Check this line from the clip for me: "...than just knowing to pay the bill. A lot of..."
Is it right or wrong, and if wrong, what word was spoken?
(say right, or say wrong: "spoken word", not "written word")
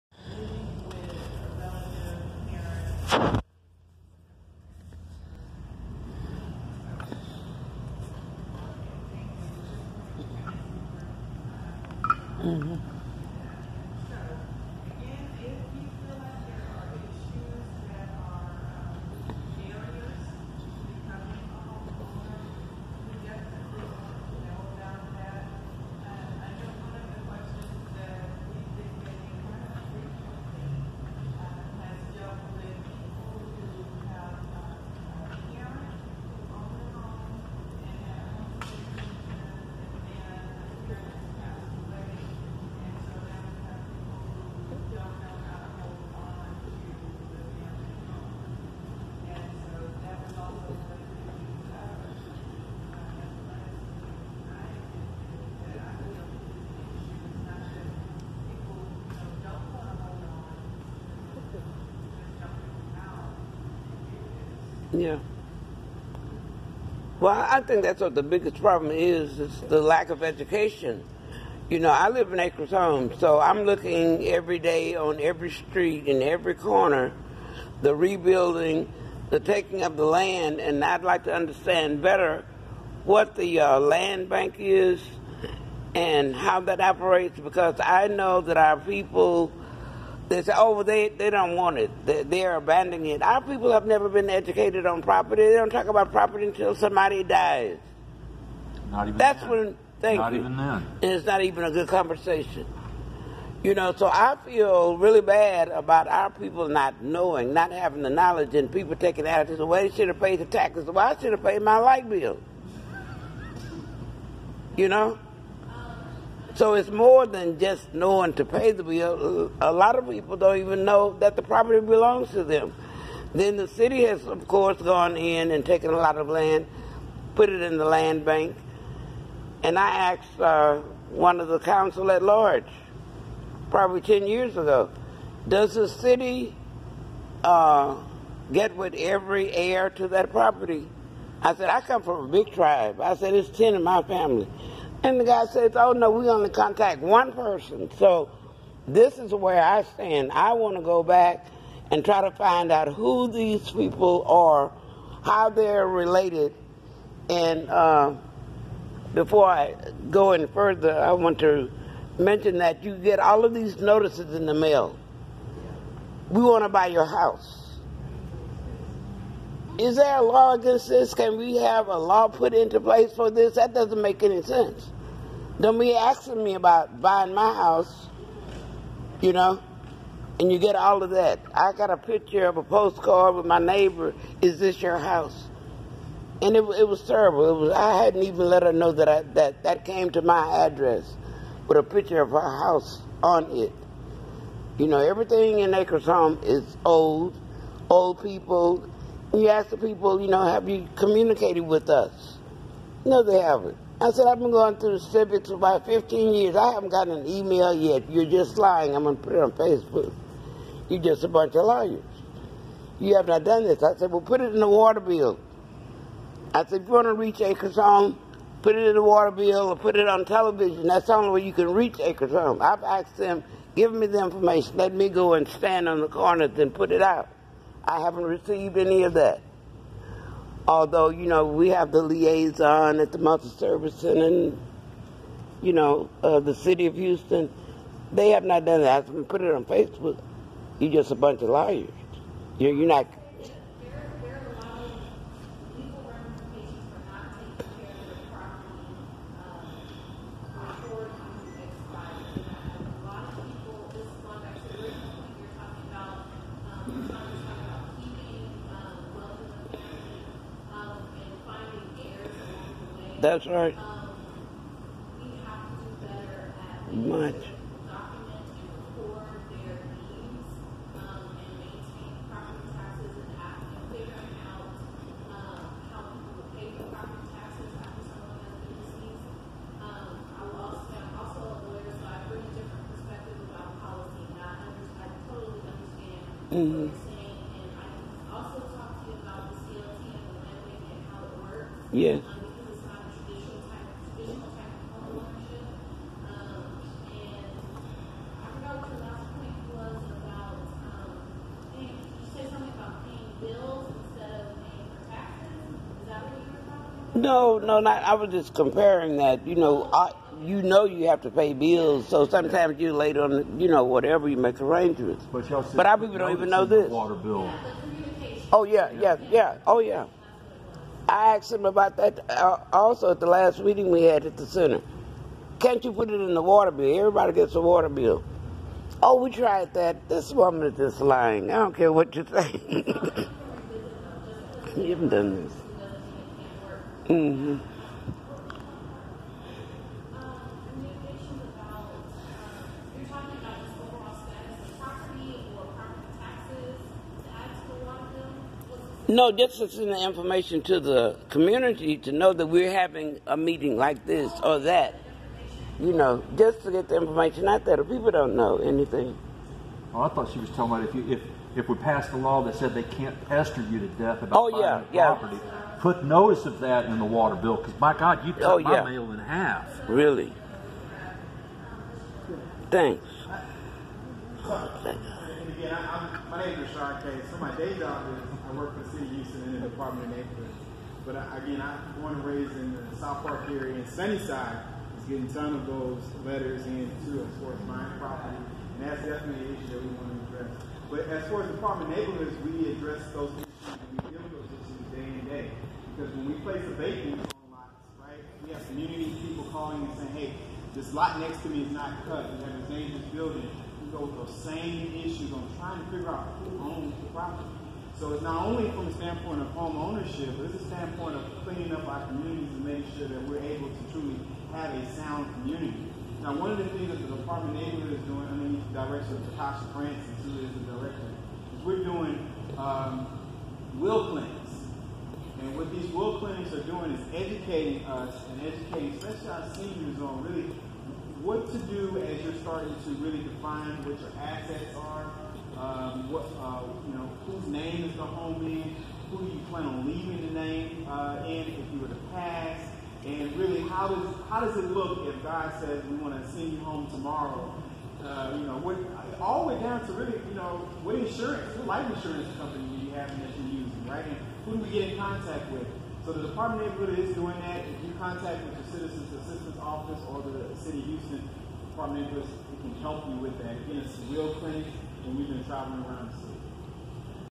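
right.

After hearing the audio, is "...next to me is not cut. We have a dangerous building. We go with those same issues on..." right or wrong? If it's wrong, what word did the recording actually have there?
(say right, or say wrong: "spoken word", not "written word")
right.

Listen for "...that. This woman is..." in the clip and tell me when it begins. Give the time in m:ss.
5:29.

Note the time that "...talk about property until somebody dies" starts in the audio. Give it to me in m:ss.
1:35.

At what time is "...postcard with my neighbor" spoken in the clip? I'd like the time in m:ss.
3:02.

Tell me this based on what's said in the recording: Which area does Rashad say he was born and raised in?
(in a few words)
South Park.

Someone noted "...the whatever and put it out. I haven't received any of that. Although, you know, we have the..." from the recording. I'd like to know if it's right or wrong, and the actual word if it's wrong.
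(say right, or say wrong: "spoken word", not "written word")
wrong: "corner", not "whatever".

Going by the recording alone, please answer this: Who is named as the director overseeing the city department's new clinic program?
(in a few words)
Tasha Francis.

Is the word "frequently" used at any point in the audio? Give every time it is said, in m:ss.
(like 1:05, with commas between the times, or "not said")
not said.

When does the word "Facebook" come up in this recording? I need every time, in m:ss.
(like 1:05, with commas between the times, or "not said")
3:29, 3:59.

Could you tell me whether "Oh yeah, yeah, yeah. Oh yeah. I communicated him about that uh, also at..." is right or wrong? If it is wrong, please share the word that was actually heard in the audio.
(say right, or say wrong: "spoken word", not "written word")
wrong: "asked", not "communicated".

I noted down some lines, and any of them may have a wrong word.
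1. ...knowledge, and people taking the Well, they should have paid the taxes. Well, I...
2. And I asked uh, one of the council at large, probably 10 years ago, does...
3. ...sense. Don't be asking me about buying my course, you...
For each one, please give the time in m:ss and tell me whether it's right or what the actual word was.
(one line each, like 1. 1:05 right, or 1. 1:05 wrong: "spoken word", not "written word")
1. 1:48 right
2. 2:09 right
3. 2:54 wrong: "house", not "course".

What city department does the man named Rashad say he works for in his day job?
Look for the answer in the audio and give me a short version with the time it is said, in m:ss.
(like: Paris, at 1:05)
Department of Neighborhoods, at 6:19.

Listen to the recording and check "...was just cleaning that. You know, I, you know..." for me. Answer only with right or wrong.
wrong.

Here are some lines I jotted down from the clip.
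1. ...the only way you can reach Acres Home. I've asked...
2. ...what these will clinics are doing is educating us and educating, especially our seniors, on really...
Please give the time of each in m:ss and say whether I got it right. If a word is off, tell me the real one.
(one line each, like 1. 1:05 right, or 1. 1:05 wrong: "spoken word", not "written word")
1. 3:41 right
2. 7:05 right.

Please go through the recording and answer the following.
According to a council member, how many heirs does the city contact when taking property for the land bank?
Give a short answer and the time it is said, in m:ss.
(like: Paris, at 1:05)
One person, at 2:27.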